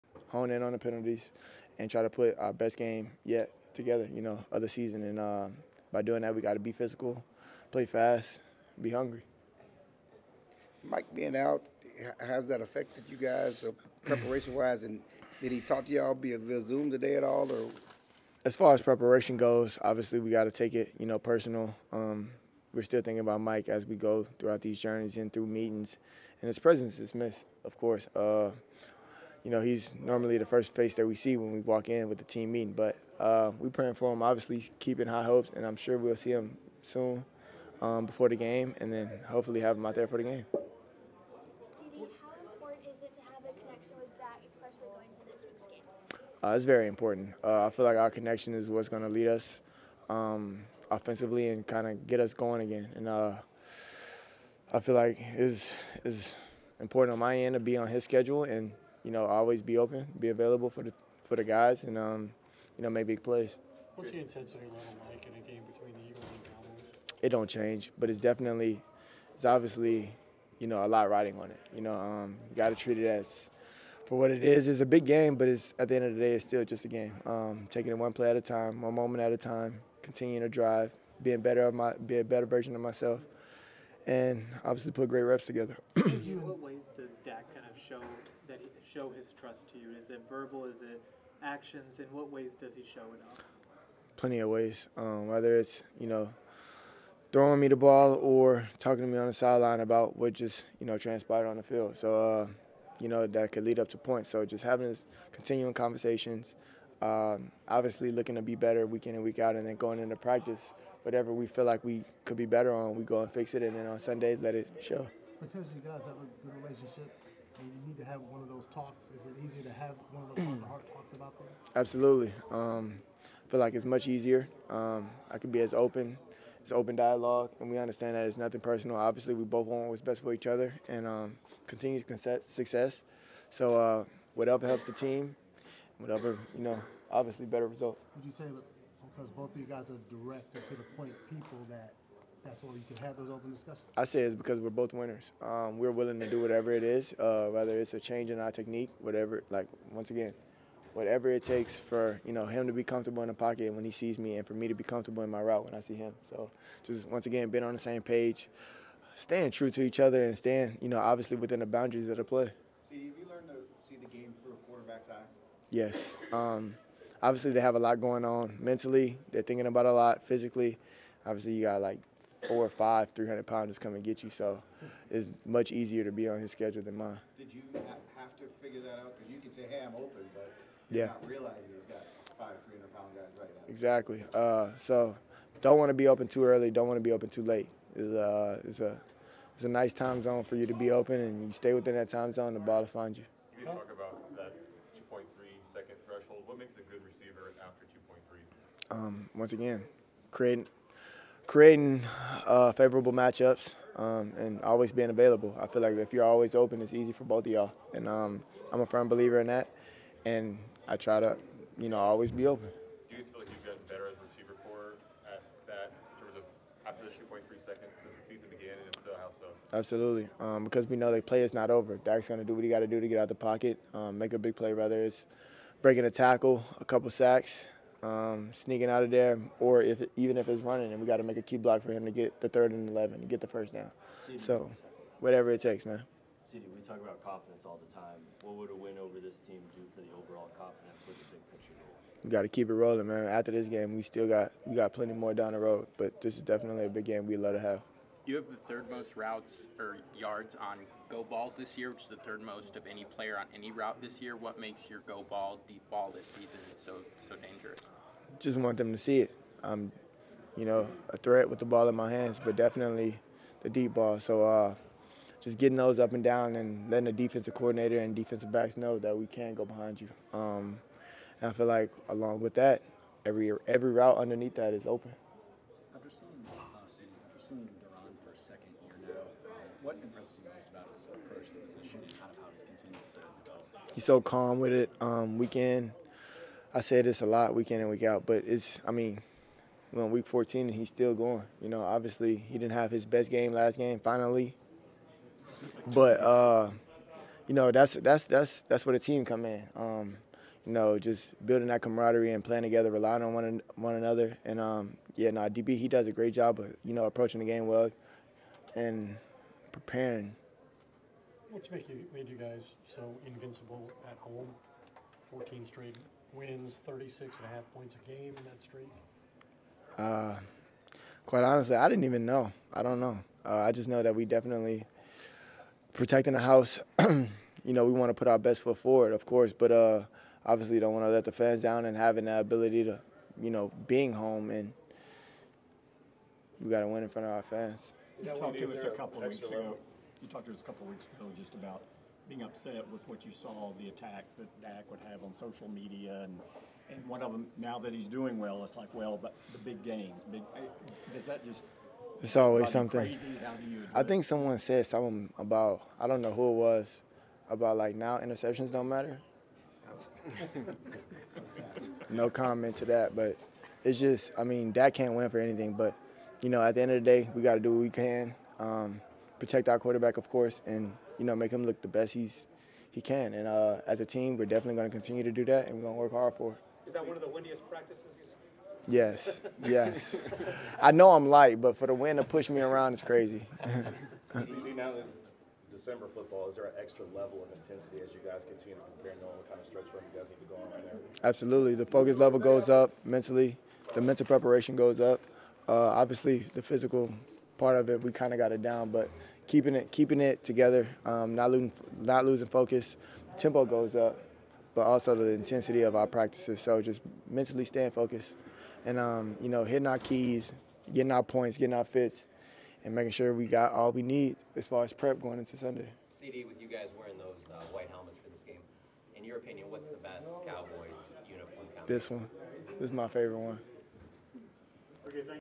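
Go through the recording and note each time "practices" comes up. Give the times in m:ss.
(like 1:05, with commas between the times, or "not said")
1:50, 6:17, 6:46.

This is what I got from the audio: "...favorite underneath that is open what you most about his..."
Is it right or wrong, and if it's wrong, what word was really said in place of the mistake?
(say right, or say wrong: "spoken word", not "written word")
wrong: "route", not "favorite".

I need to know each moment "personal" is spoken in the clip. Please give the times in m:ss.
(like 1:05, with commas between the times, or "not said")
0:21, 2:08.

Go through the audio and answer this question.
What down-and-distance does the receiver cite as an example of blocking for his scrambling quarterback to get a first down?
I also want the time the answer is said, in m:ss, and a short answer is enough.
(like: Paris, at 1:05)
Third and 11, at 3:52.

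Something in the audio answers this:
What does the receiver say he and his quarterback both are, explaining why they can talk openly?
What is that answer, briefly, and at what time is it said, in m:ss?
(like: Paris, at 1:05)
Winners, at 2:24.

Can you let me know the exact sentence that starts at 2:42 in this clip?
See, have you learned to see the game through a quarterback's eyes?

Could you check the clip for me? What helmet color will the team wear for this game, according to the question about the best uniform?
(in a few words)
White.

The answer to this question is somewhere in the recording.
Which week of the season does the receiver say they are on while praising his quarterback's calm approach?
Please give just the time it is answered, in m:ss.
4:50.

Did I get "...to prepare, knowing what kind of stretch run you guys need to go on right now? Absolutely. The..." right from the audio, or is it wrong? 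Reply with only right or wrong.
right.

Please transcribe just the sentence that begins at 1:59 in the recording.
Is it easier to have one of those heart-to-heart talks about this?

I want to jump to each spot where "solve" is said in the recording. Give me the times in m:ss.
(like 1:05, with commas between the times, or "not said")
not said.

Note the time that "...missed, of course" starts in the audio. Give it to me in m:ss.
0:27.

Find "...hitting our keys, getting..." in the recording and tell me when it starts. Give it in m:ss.
6:49.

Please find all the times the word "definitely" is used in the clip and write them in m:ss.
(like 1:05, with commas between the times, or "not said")
1:08, 4:06, 4:22, 5:24, 6:14.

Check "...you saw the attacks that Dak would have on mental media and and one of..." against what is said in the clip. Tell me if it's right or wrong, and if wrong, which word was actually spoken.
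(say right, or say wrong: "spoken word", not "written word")
wrong: "social", not "mental".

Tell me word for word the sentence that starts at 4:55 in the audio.
But, uh, you know, that's, that's, that's, that's where the team come in.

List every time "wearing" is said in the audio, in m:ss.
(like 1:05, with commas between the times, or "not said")
6:56.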